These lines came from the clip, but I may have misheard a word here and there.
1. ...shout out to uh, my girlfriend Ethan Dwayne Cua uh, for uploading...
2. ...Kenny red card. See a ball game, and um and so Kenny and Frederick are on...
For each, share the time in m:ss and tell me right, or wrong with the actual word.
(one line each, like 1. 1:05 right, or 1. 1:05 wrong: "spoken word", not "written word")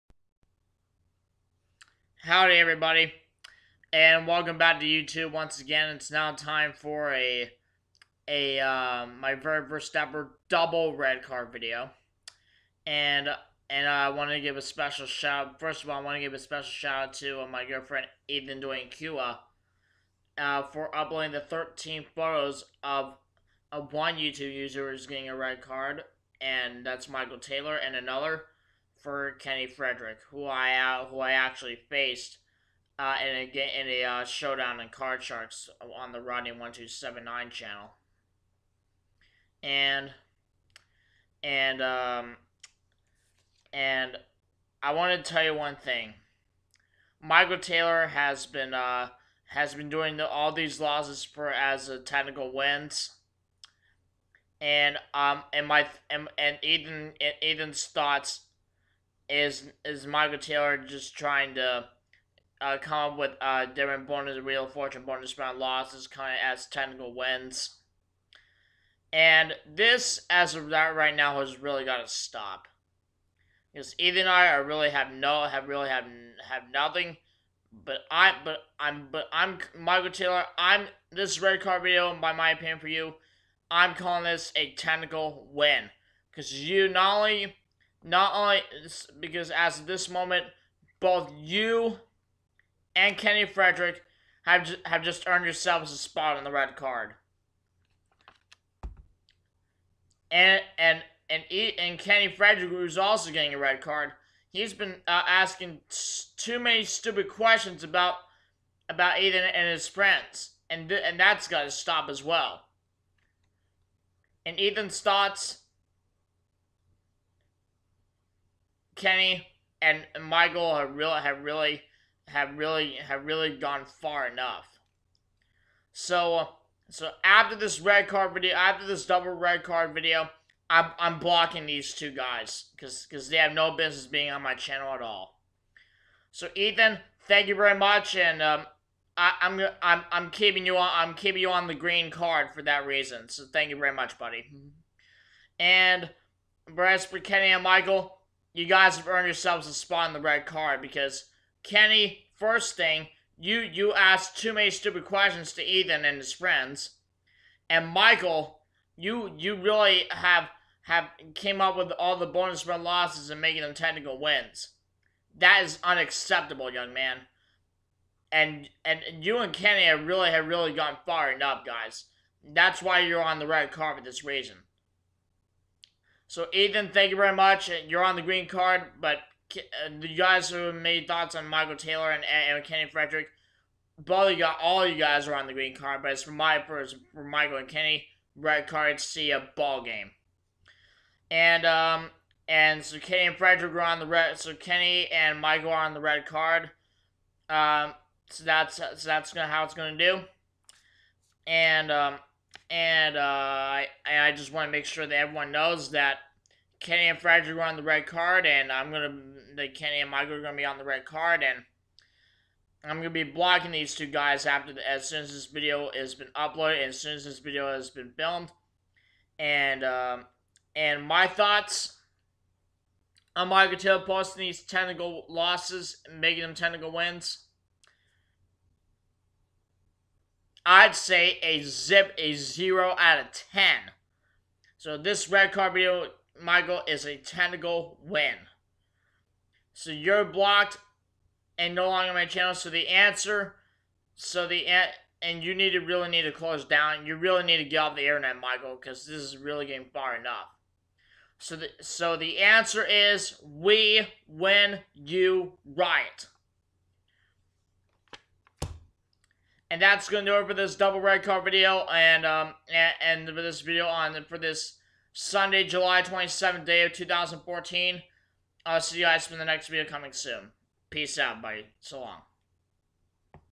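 1. 0:16 right
2. 3:07 right.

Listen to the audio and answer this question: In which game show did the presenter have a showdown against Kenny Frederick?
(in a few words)
Card Sharks.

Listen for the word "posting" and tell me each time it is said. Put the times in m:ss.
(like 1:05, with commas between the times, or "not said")
3:44.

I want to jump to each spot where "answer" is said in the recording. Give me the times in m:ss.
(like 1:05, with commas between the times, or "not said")
4:02, 4:12.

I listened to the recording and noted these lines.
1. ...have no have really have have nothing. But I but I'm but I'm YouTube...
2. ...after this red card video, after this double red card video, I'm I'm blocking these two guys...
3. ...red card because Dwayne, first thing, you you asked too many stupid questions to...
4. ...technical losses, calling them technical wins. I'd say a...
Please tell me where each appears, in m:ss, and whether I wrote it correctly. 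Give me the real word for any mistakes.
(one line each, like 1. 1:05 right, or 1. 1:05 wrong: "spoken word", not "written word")
1. 1:14 wrong: "Michael", not "YouTube"
2. 2:07 right
3. 2:30 wrong: "Kenny", not "Dwayne"
4. 3:44 wrong: "making", not "calling".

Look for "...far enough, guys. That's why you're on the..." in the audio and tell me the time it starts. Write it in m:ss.
2:51.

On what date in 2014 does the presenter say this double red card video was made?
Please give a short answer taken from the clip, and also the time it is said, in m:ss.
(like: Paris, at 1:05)
July 27th, at 4:25.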